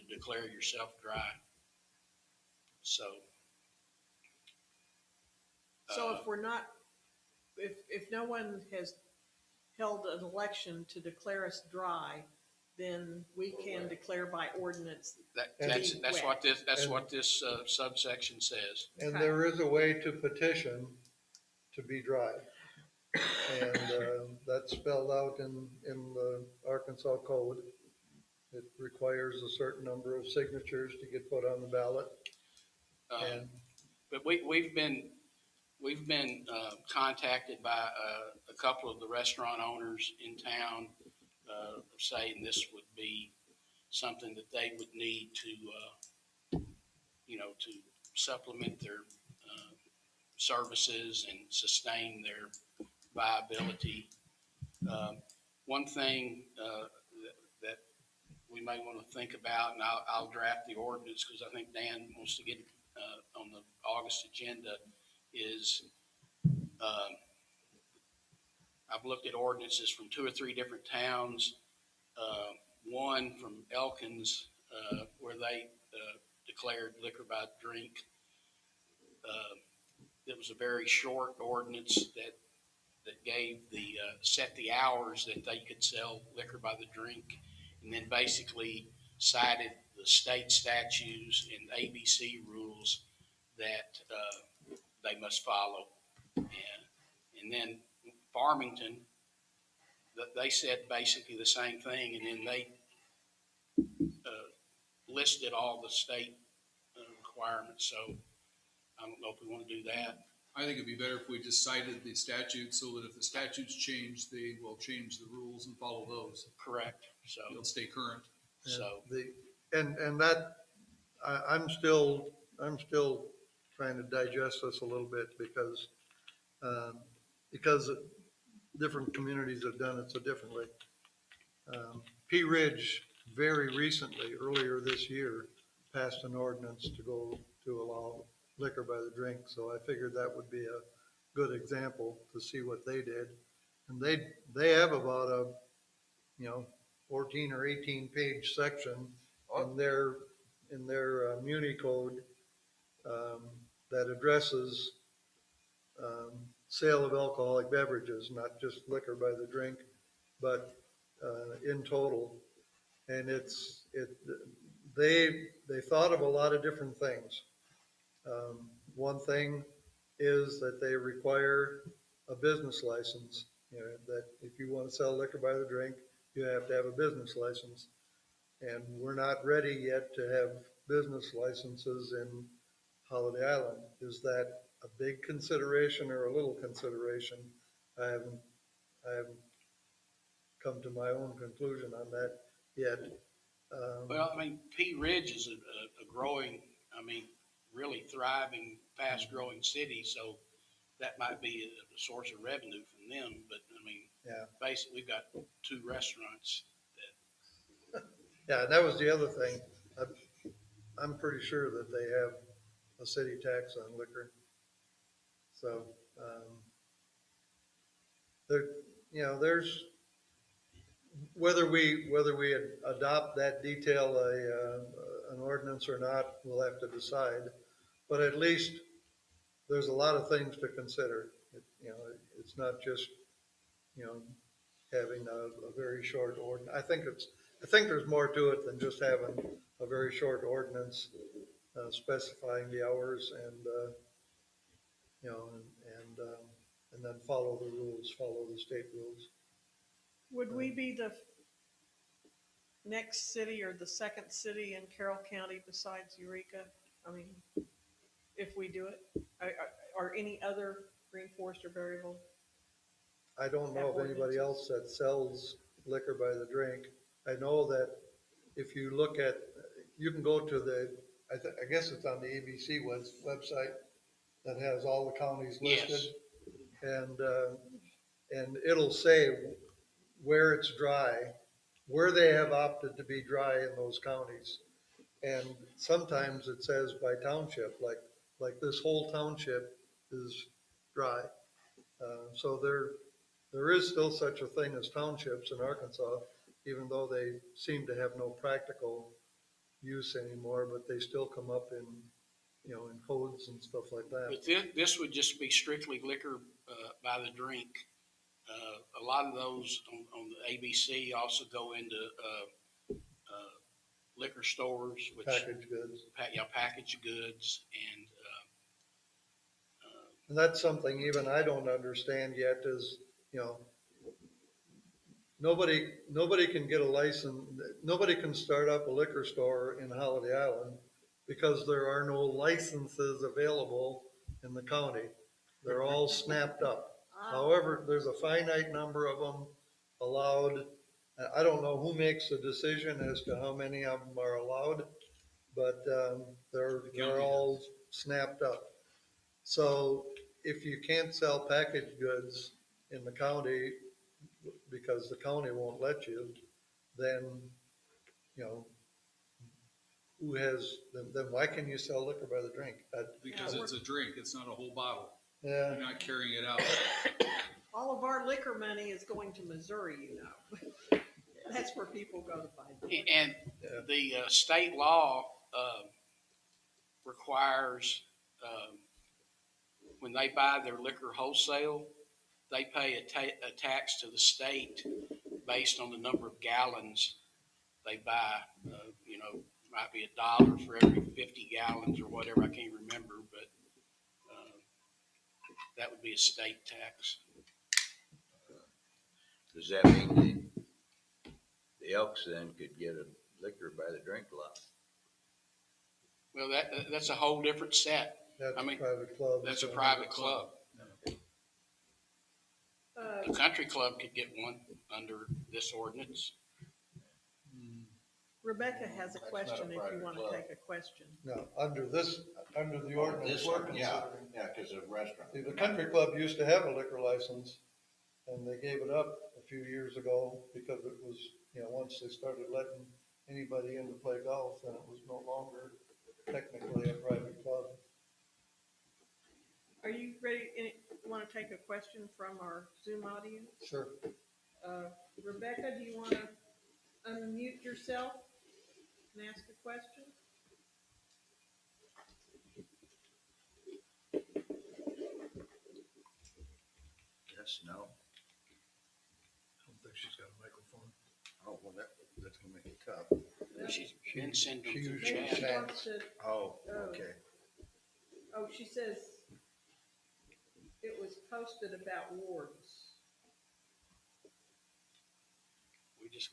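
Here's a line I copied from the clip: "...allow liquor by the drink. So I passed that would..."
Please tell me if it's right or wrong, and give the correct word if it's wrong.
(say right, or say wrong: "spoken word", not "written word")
wrong: "figured", not "passed".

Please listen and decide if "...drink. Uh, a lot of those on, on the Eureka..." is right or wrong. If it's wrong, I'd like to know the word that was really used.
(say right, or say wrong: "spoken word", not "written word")
wrong: "ABC", not "Eureka".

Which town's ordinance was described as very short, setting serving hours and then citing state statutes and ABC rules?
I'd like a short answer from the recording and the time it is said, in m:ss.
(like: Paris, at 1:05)
Elkins, at 1:13.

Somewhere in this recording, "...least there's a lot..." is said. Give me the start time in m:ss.
3:48.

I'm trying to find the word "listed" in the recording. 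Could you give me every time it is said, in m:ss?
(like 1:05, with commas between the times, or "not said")
1:45, 4:35.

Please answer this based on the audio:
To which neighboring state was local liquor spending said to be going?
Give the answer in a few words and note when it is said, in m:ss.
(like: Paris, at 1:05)
Missouri, at 6:09.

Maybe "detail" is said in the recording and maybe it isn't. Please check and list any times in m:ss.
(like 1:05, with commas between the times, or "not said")
3:43.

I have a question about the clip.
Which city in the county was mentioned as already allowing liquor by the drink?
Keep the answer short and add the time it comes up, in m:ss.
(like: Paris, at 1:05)
Eureka, at 4:16.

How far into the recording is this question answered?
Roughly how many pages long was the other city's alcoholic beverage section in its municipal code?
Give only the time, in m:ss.
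2:27.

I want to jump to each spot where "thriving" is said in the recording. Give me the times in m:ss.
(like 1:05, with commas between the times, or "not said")
3:18.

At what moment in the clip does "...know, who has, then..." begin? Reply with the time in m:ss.
5:58.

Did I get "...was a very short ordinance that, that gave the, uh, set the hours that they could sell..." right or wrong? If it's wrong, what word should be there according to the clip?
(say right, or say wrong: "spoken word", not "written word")
right.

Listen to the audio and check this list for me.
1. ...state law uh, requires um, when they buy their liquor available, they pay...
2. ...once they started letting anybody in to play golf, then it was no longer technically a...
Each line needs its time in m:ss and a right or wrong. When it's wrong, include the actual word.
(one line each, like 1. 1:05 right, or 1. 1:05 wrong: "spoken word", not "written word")
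1. 6:14 wrong: "wholesale", not "available"
2. 7:11 right.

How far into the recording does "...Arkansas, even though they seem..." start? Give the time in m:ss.
4:55.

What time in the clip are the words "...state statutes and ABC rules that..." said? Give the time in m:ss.
1:30.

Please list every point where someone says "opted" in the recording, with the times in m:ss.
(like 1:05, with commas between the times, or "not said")
4:42.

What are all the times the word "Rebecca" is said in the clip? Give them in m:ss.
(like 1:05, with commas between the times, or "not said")
6:58, 7:25.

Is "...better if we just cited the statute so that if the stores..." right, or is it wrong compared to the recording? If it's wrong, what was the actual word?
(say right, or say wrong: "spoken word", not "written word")
wrong: "statutes", not "stores".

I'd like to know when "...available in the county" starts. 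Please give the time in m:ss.
5:33.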